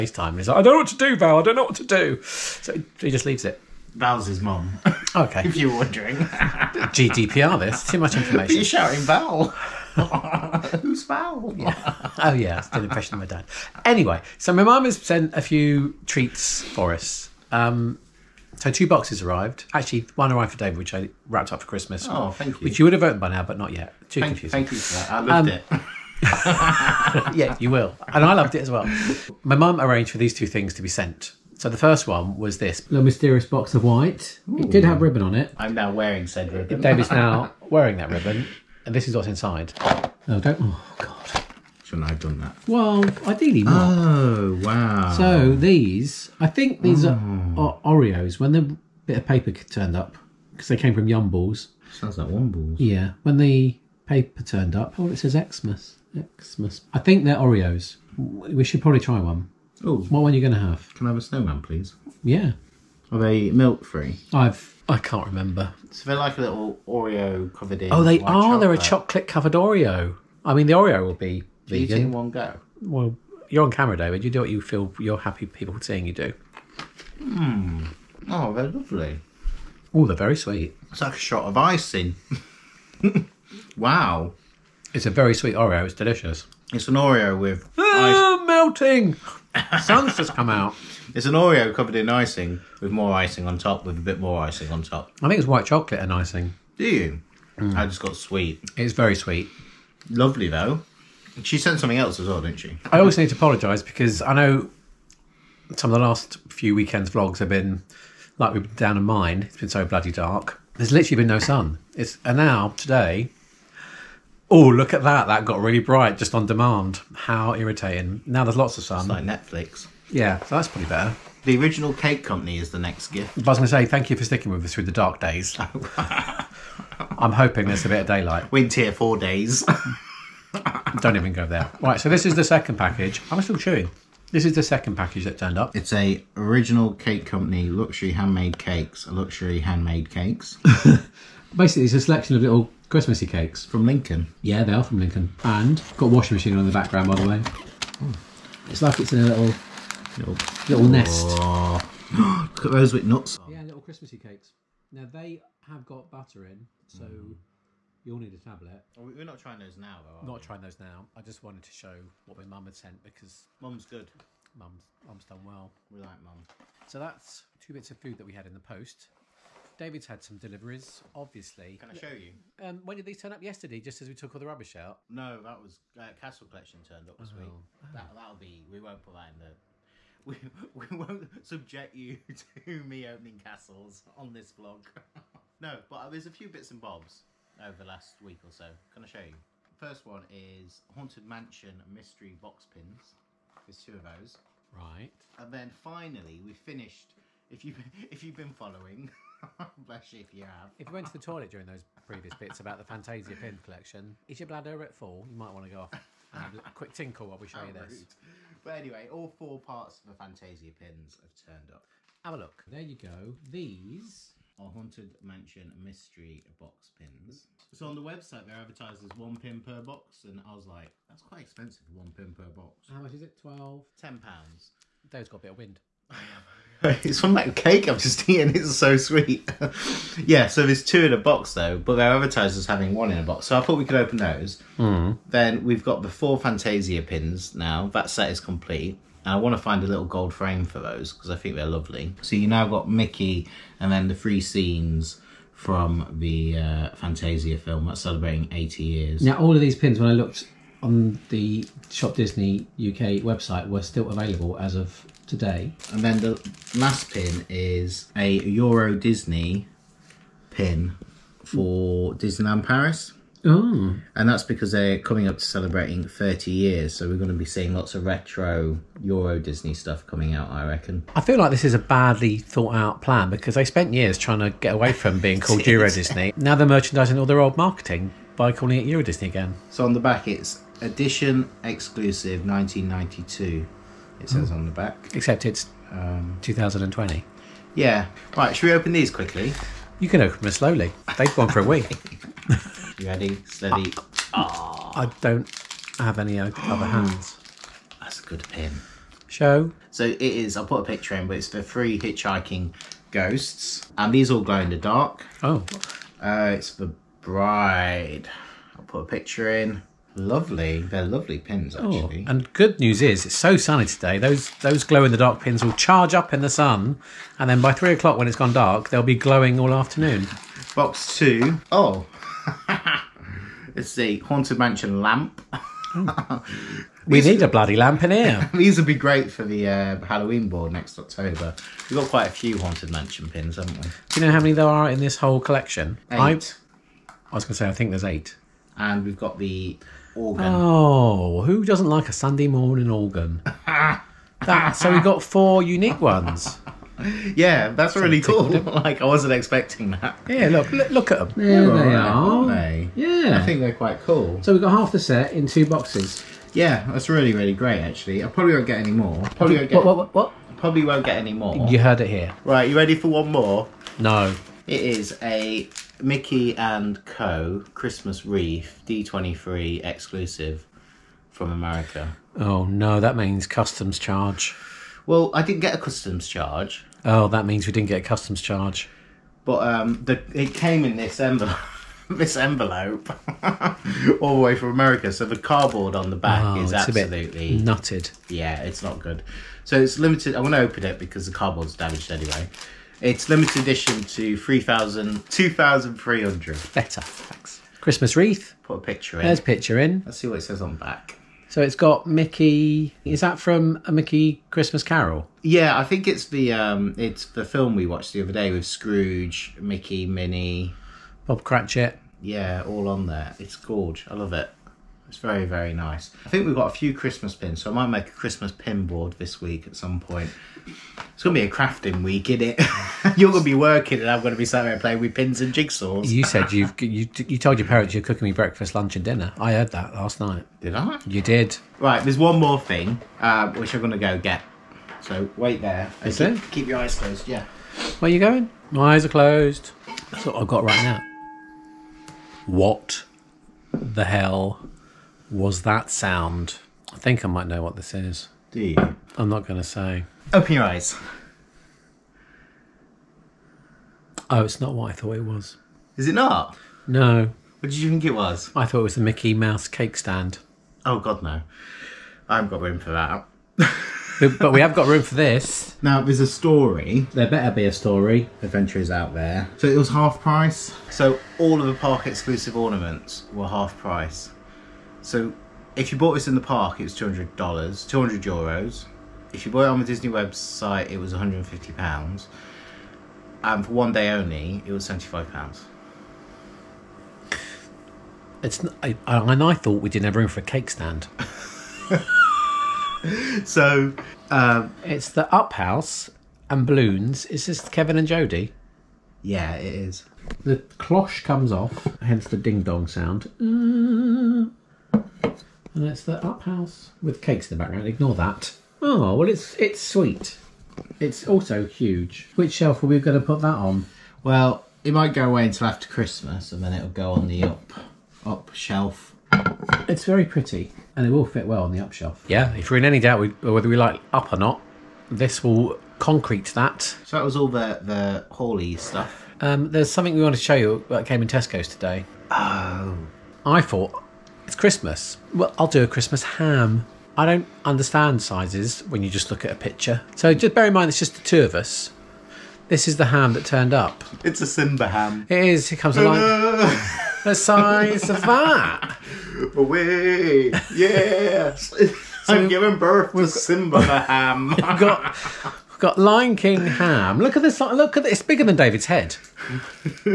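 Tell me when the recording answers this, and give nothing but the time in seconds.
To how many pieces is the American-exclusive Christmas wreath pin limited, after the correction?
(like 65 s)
395 s.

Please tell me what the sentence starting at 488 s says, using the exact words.
It's I, I, and I thought we didn't have room for a cake stand.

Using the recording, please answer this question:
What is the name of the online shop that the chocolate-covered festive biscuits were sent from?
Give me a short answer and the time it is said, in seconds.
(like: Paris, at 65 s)
Yumbles, at 51 s.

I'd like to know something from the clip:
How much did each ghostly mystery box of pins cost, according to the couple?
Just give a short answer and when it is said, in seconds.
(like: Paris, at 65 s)
£10, at 223 s.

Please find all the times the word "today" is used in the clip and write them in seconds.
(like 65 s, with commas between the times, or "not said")
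112 s, 255 s, 313 s, 531 s.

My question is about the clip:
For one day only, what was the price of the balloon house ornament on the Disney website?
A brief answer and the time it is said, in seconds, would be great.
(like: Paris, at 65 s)
£75, at 484 s.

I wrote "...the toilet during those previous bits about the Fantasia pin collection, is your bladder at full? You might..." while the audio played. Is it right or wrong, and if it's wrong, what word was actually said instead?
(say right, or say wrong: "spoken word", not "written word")
right.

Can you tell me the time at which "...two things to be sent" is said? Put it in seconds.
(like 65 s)
30 s.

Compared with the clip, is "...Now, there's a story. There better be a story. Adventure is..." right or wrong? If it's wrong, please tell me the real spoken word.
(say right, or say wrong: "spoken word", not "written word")
right.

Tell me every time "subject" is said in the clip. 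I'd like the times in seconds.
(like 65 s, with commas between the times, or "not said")
181 s.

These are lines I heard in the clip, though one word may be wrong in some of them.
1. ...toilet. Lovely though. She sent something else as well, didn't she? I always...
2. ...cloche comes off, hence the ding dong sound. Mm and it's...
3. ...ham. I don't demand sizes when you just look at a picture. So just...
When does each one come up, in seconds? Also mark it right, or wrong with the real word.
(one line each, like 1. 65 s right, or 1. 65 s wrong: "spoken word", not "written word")
1. 99 s wrong: "sweet", not "toilet"
2. 500 s right
3. 536 s wrong: "understand", not "demand".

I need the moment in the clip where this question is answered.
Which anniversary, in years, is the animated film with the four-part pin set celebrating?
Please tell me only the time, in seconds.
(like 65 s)
248 s.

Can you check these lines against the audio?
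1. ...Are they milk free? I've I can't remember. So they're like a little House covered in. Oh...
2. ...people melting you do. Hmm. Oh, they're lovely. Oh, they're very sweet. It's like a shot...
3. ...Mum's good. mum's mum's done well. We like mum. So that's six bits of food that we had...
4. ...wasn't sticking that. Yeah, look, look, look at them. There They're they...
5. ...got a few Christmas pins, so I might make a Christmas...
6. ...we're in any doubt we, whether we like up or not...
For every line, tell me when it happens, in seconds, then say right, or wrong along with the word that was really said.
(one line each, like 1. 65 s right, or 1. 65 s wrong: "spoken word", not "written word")
1. 63 s wrong: "Oreo", not "House"
2. 75 s wrong: "seeing", not "melting"
3. 163 s wrong: "two", not "six"
4. 349 s wrong: "expecting", not "sticking"
5. 416 s right
6. 522 s right.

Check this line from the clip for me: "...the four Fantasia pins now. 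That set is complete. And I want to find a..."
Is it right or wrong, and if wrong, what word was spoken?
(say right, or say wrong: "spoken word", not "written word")
right.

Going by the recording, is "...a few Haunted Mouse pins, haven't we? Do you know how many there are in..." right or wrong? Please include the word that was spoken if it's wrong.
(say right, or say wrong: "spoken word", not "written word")
wrong: "Mansion", not "Mouse".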